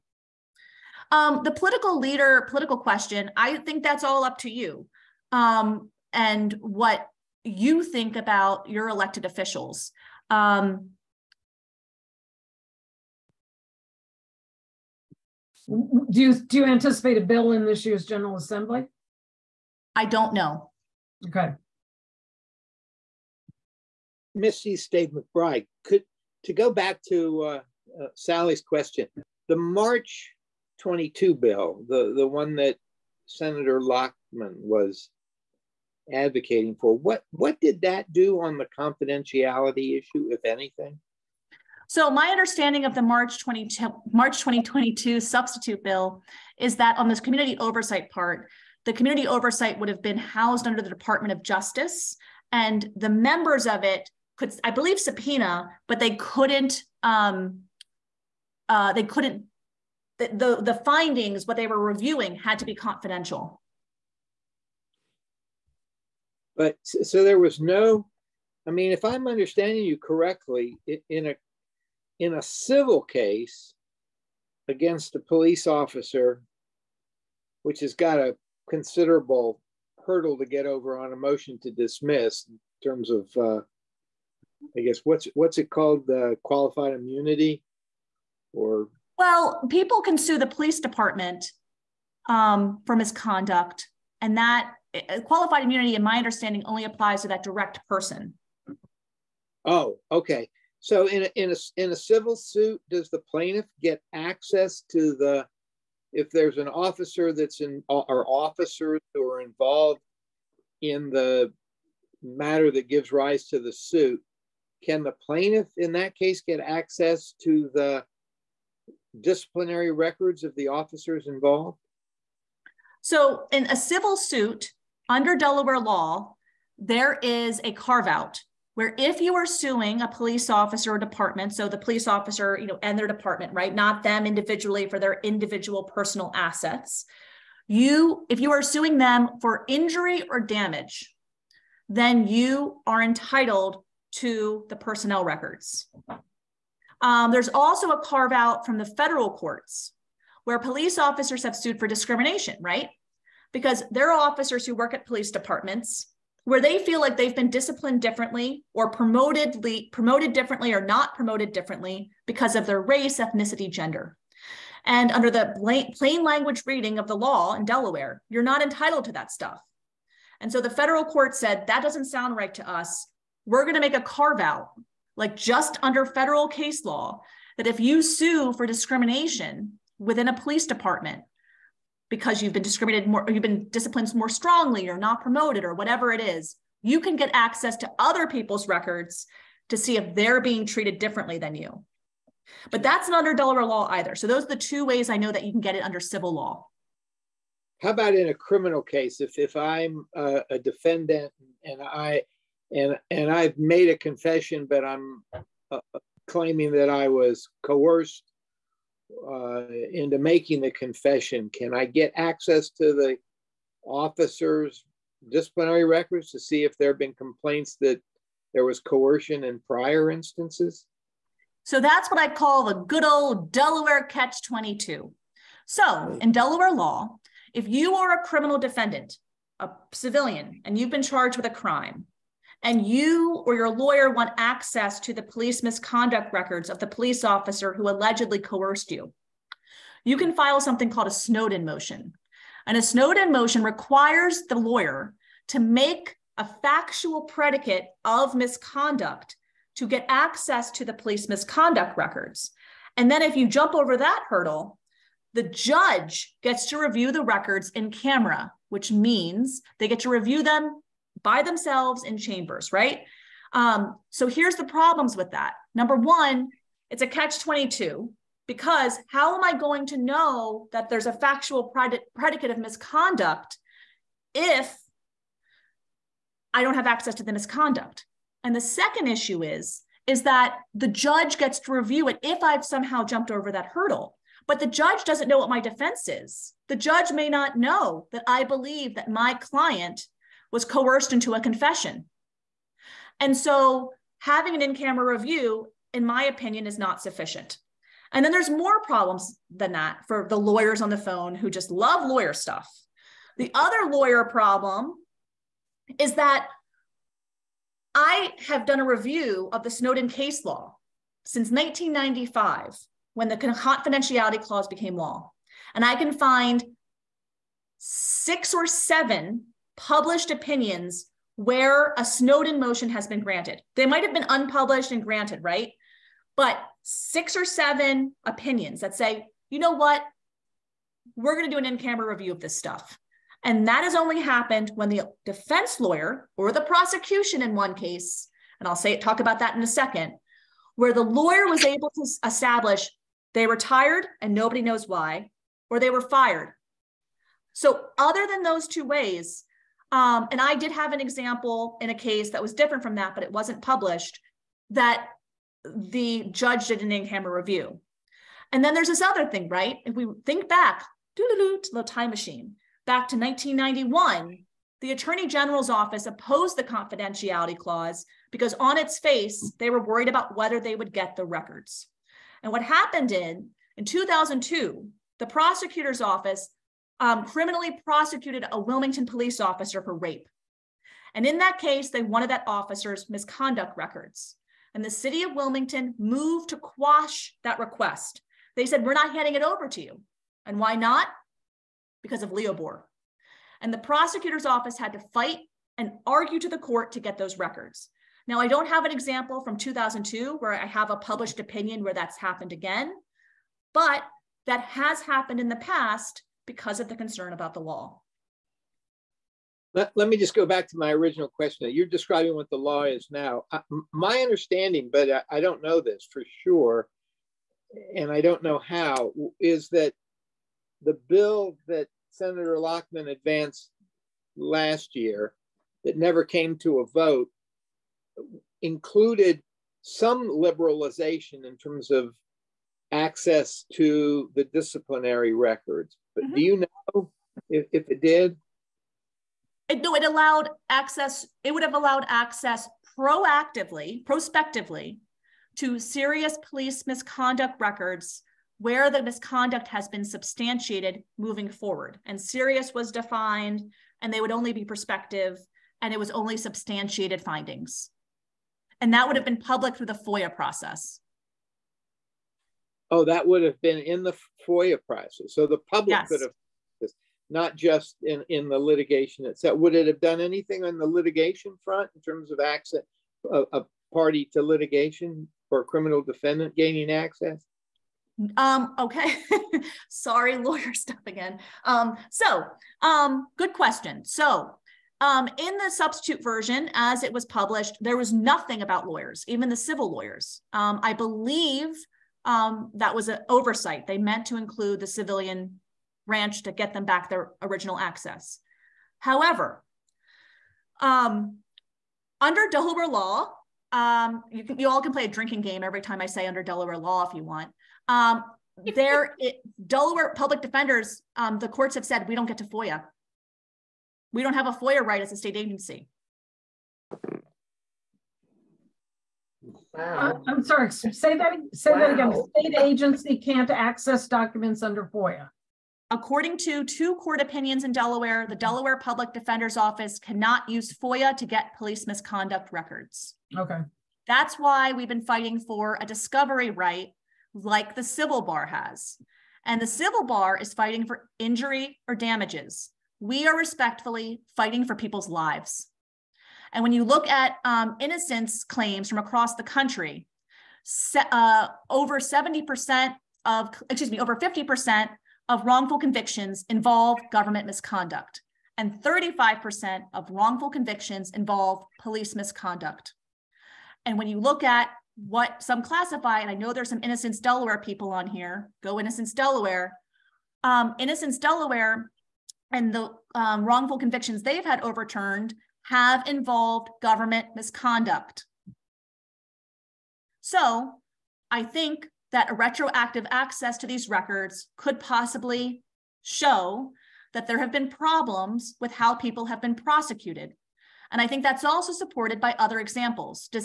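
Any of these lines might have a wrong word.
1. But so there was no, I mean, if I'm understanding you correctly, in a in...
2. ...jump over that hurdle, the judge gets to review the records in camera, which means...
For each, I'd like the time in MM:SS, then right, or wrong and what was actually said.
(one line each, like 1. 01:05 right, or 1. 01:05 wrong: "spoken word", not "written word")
1. 01:06 right
2. 04:13 right.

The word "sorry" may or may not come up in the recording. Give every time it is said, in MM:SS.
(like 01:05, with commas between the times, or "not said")
07:59, 08:40.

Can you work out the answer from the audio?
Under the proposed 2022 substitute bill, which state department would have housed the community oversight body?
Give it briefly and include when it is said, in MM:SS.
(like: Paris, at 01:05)
Department of Justice, at 00:50.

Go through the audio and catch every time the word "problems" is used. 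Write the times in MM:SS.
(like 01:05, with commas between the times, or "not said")
04:24, 04:58, 05:04, 09:47.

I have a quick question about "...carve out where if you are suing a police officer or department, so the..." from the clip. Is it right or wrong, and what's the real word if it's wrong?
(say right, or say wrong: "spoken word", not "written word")
right.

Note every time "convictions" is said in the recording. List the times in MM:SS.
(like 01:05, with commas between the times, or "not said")
09:15, 09:20, 09:33.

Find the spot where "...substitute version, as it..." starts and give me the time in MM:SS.
08:05.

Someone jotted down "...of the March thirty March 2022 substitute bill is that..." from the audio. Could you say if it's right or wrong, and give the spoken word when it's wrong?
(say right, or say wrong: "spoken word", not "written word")
wrong: "twenty", not "thirty".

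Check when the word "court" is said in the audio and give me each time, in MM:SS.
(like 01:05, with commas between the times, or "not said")
02:29, 02:51, 06:36, 08:31, 08:46.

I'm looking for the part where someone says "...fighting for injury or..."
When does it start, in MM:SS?
09:00.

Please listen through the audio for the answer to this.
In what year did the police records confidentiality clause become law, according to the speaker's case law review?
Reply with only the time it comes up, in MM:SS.
05:11.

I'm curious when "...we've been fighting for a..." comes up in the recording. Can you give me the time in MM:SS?
08:54.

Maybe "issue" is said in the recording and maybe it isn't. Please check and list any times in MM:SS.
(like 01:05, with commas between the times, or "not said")
00:39, 04:39.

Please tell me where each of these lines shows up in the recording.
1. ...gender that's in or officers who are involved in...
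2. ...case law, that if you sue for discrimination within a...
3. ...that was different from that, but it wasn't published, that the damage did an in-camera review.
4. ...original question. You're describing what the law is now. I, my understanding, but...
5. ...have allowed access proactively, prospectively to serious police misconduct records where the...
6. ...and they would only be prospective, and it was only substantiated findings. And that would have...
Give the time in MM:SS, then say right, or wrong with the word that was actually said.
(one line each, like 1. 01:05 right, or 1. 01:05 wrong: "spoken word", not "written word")
1. 01:46 wrong: "officer", not "gender"
2. 02:56 right
3. 05:52 wrong: "judge", not "damage"
4. 06:50 right
5. 07:21 right
6. 07:34 right.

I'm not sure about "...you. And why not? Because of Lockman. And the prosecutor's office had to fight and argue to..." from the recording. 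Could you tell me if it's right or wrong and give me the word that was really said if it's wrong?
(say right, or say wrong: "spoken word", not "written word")
wrong: "Leobor", not "Lockman".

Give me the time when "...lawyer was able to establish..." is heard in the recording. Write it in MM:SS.
05:41.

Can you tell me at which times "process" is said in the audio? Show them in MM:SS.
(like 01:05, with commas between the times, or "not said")
07:40, 07:44.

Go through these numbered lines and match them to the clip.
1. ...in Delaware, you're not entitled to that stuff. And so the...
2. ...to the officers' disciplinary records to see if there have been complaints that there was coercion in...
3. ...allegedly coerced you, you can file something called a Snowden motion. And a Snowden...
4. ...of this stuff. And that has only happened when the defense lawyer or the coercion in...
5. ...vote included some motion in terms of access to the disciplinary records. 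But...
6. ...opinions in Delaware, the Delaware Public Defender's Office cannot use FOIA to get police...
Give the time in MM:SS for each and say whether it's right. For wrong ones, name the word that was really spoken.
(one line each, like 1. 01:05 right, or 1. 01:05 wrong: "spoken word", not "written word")
1. 02:47 right
2. 03:32 right
3. 03:57 right
4. 05:32 wrong: "prosecution", not "coercion"
5. 07:06 wrong: "liberalization", not "motion"
6. 08:47 right.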